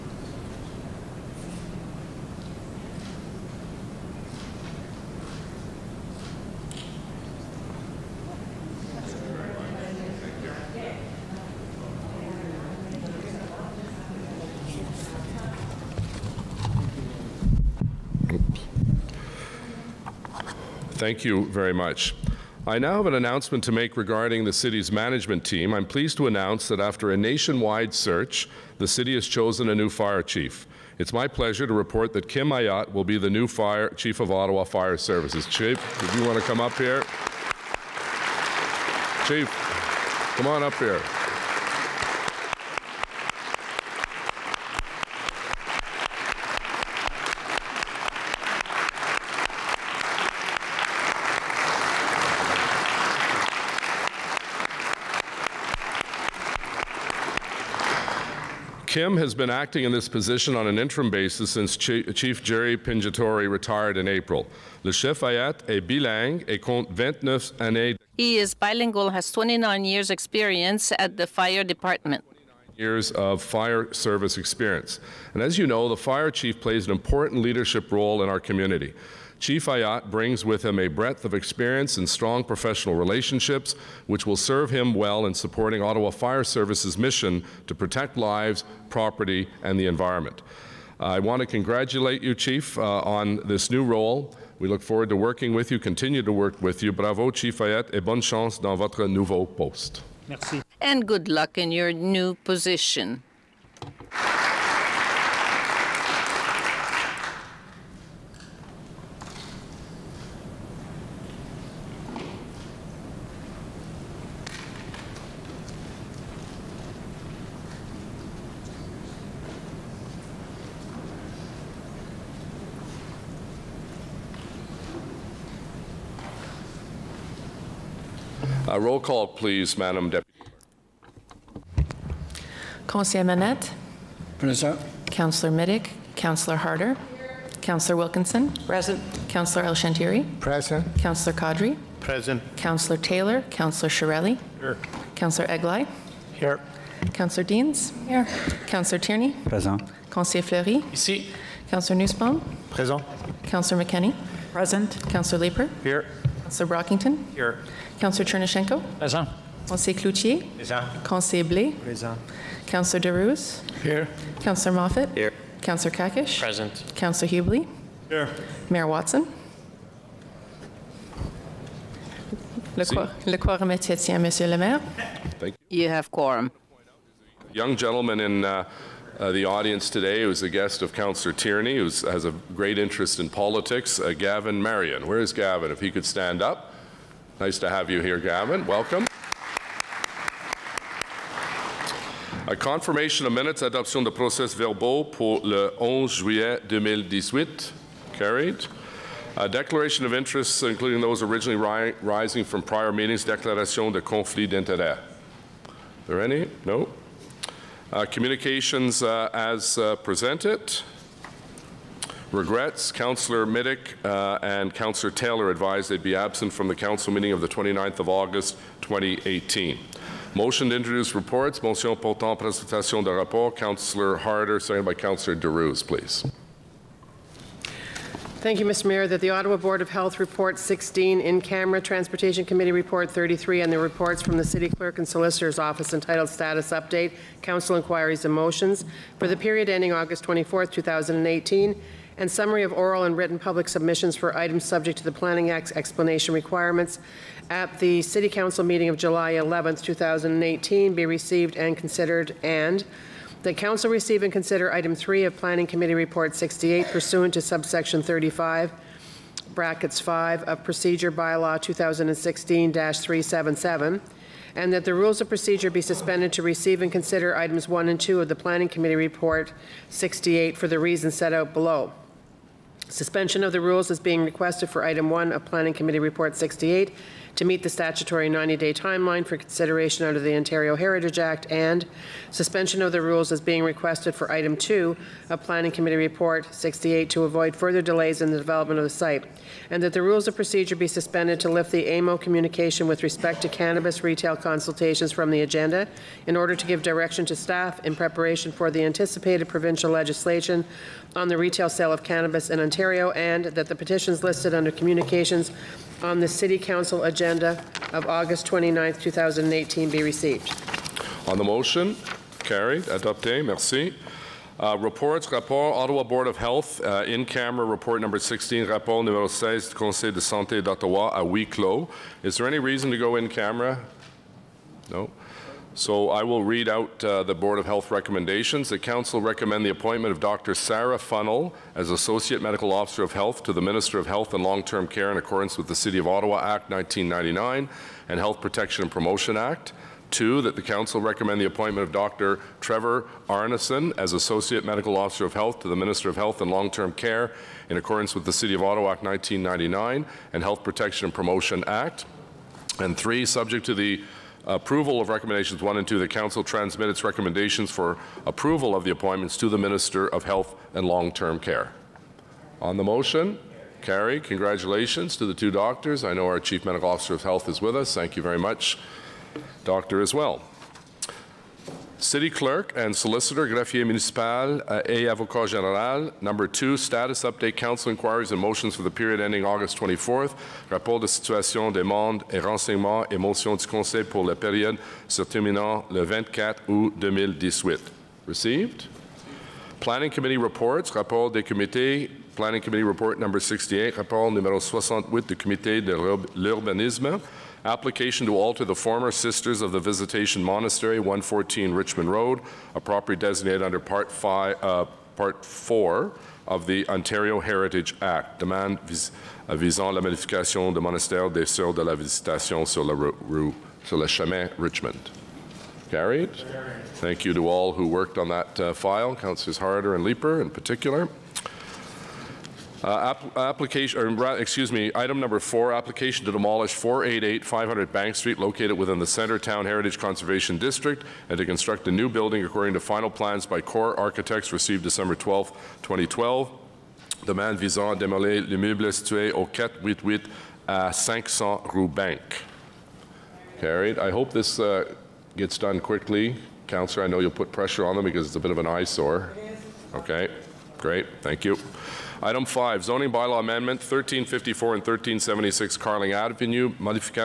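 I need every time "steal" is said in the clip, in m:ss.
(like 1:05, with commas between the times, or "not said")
not said.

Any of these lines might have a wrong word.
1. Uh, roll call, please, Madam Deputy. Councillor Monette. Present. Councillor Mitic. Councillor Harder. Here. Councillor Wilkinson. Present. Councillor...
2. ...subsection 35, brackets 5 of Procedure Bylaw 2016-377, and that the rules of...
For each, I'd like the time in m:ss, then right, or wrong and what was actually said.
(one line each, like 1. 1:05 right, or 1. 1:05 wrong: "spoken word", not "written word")
1. 2:08 right
2. 4:17 right.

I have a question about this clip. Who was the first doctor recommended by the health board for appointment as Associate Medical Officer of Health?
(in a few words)
Dr. Sarah Funnell.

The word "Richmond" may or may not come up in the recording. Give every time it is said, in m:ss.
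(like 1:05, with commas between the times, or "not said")
6:41, 6:54.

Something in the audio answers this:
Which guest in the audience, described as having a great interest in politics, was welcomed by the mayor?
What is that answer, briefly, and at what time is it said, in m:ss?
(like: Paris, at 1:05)
Gavin Marion, at 3:04.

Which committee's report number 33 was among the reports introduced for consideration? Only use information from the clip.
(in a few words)
Transportation Committee.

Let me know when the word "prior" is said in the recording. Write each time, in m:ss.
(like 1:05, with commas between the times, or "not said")
3:22.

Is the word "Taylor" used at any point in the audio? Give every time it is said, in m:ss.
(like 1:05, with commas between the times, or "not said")
2:22, 3:35.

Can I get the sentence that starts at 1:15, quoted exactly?
And as you know, the fire chief plays an important leadership role in our community.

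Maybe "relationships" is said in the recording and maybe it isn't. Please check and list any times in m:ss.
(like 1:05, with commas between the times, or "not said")
1:22.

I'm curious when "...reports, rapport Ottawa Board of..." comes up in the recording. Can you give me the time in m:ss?
5:14.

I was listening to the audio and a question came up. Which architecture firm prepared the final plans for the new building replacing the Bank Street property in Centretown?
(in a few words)
Core Architects.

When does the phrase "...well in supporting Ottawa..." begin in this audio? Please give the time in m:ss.
1:24.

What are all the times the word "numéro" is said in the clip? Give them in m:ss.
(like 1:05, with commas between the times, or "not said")
5:19, 6:34.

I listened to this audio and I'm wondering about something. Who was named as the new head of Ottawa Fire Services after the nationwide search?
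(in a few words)
Kim Ayotte.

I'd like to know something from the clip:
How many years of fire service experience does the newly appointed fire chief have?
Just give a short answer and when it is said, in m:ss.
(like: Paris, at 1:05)
29, at 1:09.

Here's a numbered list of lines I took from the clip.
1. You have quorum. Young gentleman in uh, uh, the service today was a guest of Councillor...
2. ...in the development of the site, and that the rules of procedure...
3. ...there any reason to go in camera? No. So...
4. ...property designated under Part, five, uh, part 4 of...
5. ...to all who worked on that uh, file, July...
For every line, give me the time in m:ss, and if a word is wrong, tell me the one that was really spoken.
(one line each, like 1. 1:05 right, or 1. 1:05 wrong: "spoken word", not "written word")
1. 2:55 wrong: "audience", not "service"
2. 4:48 right
3. 5:22 right
4. 6:42 right
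5. 6:57 wrong: "Councillors", not "July".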